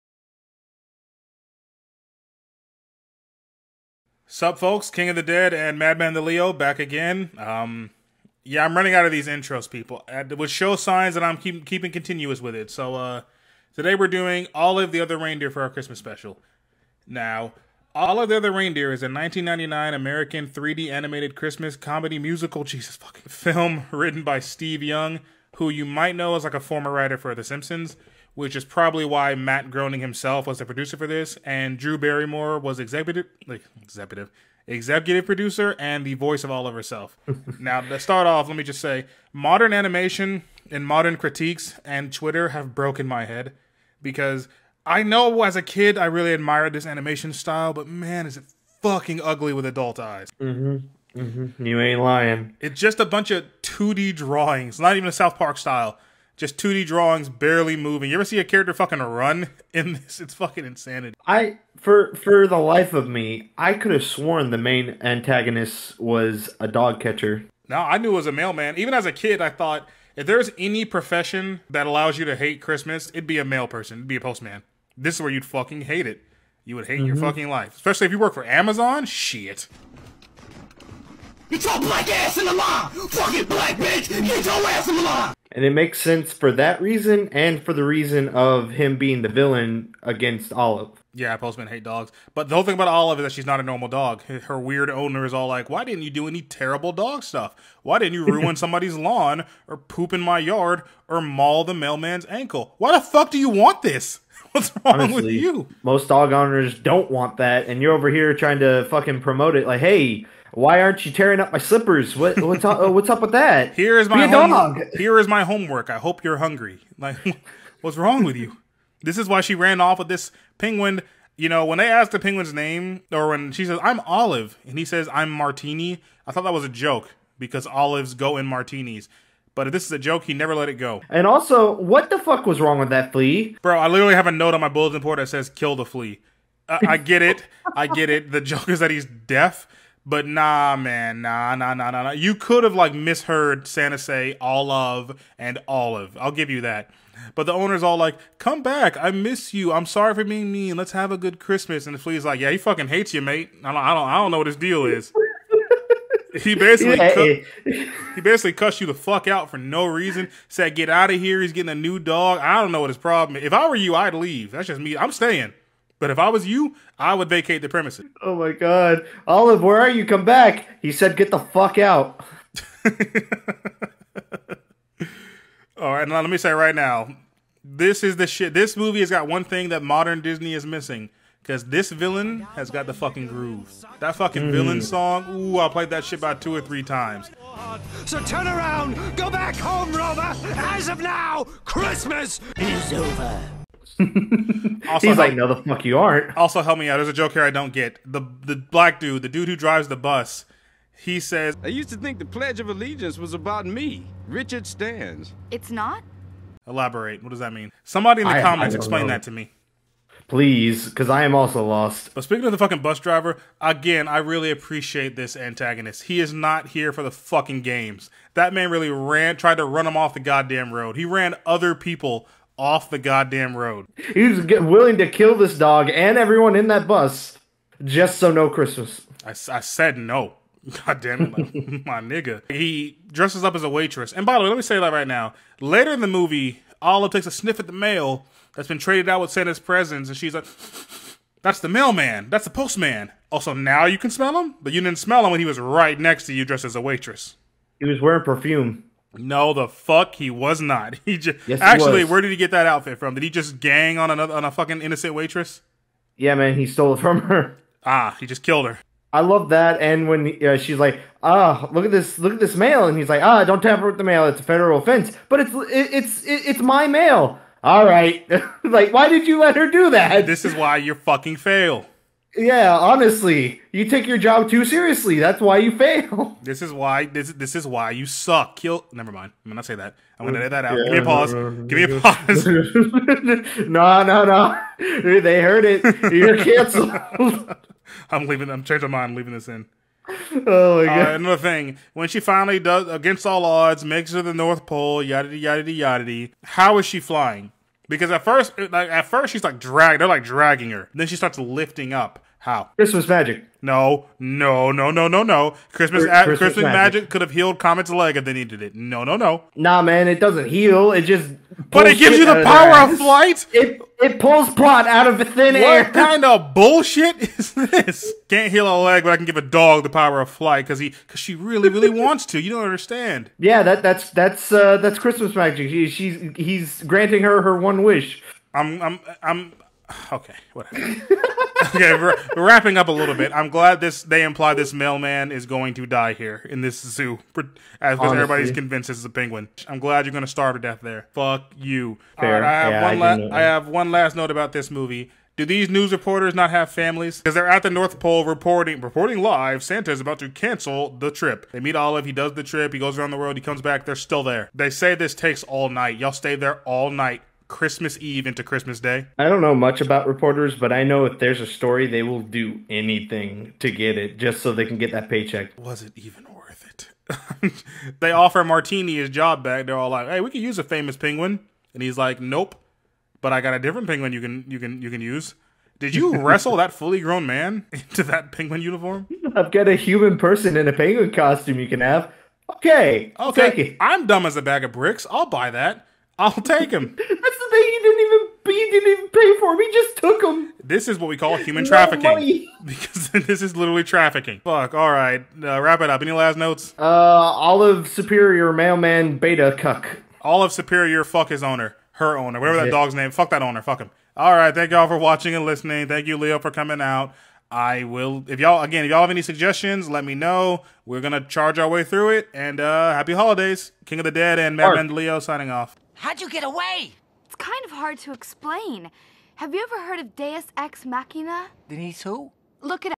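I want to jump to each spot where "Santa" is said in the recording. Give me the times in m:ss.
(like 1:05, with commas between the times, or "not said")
2:23, 3:59, 5:49.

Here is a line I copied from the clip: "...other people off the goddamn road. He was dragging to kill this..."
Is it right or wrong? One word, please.
wrong.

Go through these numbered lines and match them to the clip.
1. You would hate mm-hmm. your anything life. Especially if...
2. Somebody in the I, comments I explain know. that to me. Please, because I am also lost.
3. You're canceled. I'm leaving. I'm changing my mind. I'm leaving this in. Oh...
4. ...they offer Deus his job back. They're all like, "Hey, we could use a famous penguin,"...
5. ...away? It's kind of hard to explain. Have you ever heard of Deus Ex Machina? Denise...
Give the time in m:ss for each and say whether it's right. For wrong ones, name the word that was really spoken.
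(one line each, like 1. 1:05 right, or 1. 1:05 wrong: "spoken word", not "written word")
1. 1:16 wrong: "fucking", not "anything"
2. 3:27 right
3. 4:46 right
4. 6:07 wrong: "Martini", not "Deus"
5. 6:56 right.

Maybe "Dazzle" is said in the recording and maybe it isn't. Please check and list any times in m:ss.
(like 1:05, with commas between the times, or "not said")
not said.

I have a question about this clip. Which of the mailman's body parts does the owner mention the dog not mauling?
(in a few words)
ankle.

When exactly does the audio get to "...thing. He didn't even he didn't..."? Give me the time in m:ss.
6:27.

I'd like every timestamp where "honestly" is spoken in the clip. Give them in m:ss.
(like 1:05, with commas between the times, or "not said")
1:45, 4:32.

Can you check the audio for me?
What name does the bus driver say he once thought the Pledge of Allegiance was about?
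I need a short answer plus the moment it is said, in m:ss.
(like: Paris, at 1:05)
Richard Stans, at 3:24.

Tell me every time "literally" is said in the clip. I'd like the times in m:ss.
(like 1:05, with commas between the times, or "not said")
2:13, 6:33.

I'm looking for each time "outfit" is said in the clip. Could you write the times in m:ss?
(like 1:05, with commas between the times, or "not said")
4:12.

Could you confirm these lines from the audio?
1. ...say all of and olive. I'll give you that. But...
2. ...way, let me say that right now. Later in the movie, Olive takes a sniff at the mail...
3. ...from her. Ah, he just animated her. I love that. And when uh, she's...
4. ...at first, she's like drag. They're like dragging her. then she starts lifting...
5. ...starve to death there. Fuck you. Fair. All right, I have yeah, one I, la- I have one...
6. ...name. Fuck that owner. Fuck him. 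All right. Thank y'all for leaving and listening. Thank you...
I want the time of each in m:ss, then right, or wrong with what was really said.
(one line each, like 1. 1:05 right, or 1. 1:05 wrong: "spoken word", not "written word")
1. 2:23 right
2. 3:54 right
3. 4:16 wrong: "killed", not "animated"
4. 4:58 right
5. 5:40 right
6. 6:42 wrong: "watching", not "leaving".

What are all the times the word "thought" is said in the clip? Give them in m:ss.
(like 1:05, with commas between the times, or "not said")
1:09, 2:06.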